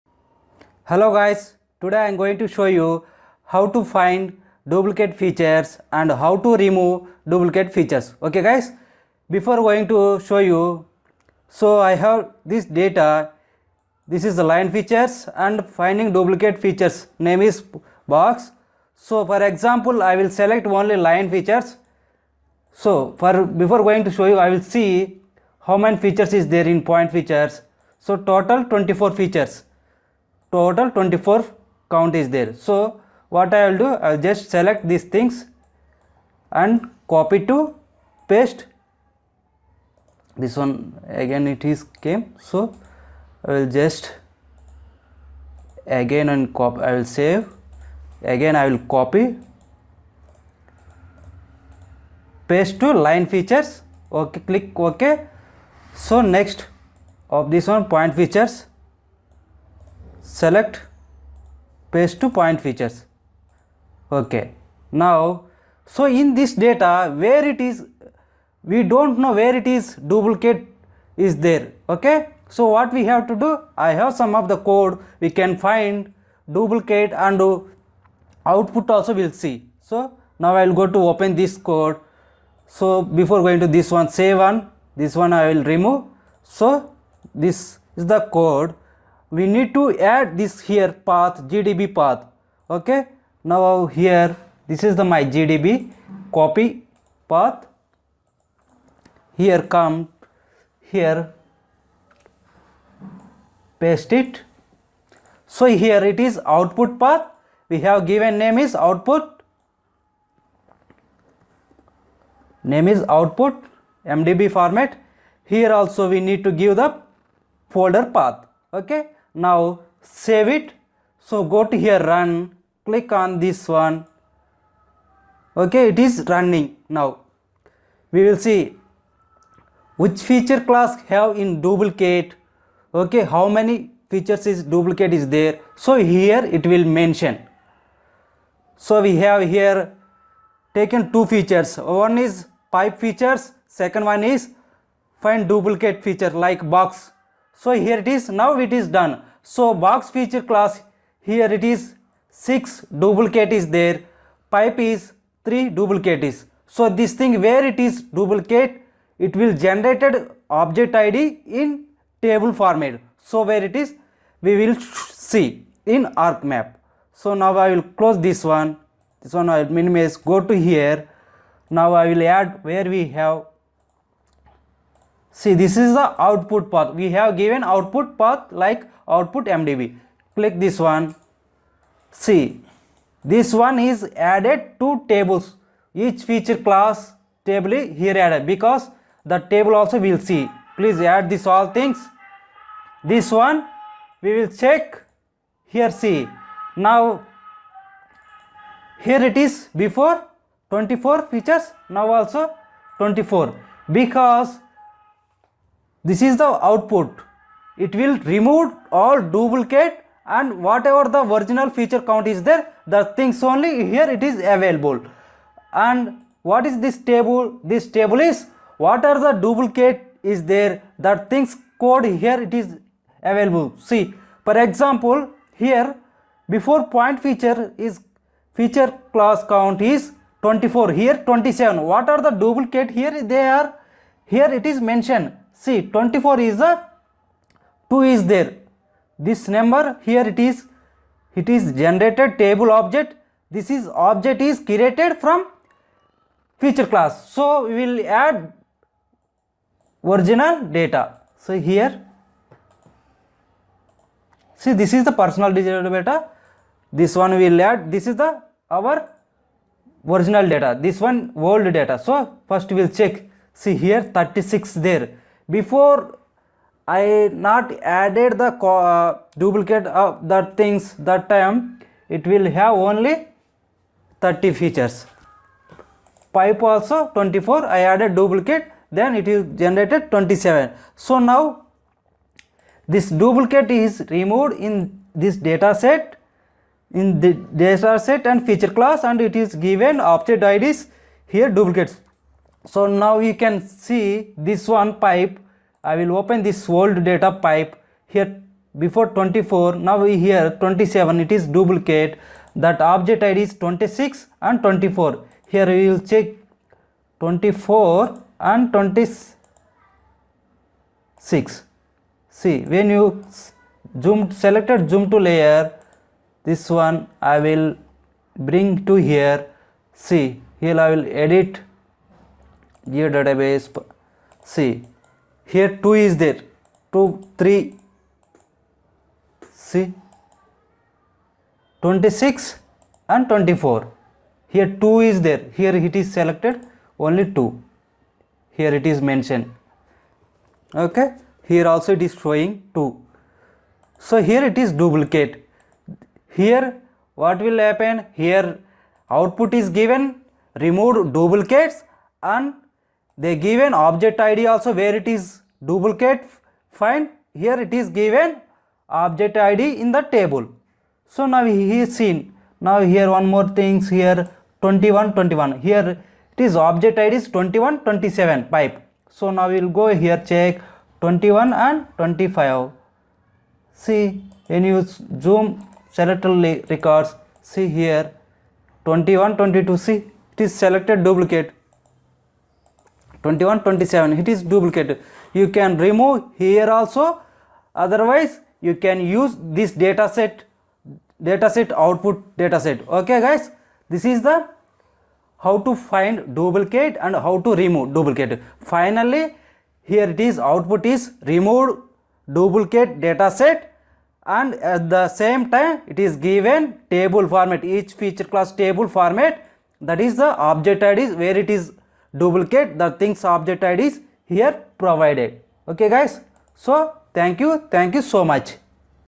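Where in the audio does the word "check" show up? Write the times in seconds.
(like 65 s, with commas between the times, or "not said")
194 s, 263 s, 306 s, 370 s.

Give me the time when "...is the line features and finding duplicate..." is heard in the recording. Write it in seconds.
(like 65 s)
14 s.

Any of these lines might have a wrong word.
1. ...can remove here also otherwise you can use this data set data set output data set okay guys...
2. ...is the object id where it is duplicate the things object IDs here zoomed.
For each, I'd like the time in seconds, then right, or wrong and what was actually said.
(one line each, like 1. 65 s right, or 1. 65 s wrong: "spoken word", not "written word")
1. 385 s right
2. 410 s wrong: "provided", not "zoomed".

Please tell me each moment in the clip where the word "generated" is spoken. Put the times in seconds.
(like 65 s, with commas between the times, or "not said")
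159 s, 241 s, 279 s.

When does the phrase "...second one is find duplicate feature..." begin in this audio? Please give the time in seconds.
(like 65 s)
143 s.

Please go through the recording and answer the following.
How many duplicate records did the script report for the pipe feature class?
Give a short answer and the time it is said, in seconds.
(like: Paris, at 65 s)
3, at 154 s.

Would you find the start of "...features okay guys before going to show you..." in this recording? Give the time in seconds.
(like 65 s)
7 s.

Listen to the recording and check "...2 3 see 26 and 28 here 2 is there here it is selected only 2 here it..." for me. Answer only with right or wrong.
wrong.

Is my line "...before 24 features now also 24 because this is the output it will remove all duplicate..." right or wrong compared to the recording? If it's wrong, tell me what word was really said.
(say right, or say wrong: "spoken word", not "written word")
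right.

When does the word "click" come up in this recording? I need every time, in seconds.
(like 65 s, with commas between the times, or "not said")
54 s, 122 s, 180 s.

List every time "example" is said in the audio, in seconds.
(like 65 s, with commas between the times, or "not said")
19 s, 224 s.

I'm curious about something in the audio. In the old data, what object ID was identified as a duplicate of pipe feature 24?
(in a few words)
26.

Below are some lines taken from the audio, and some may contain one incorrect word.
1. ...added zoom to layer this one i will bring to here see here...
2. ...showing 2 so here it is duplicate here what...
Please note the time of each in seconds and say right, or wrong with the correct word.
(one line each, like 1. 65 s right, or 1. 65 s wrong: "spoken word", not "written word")
1. 314 s wrong: "selected", not "added"
2. 342 s right.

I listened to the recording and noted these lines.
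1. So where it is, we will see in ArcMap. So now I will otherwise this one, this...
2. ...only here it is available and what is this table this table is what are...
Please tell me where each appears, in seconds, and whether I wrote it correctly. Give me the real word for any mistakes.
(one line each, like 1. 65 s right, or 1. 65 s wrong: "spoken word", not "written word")
1. 163 s wrong: "close", not "otherwise"
2. 213 s right.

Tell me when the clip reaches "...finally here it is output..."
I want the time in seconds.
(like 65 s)
398 s.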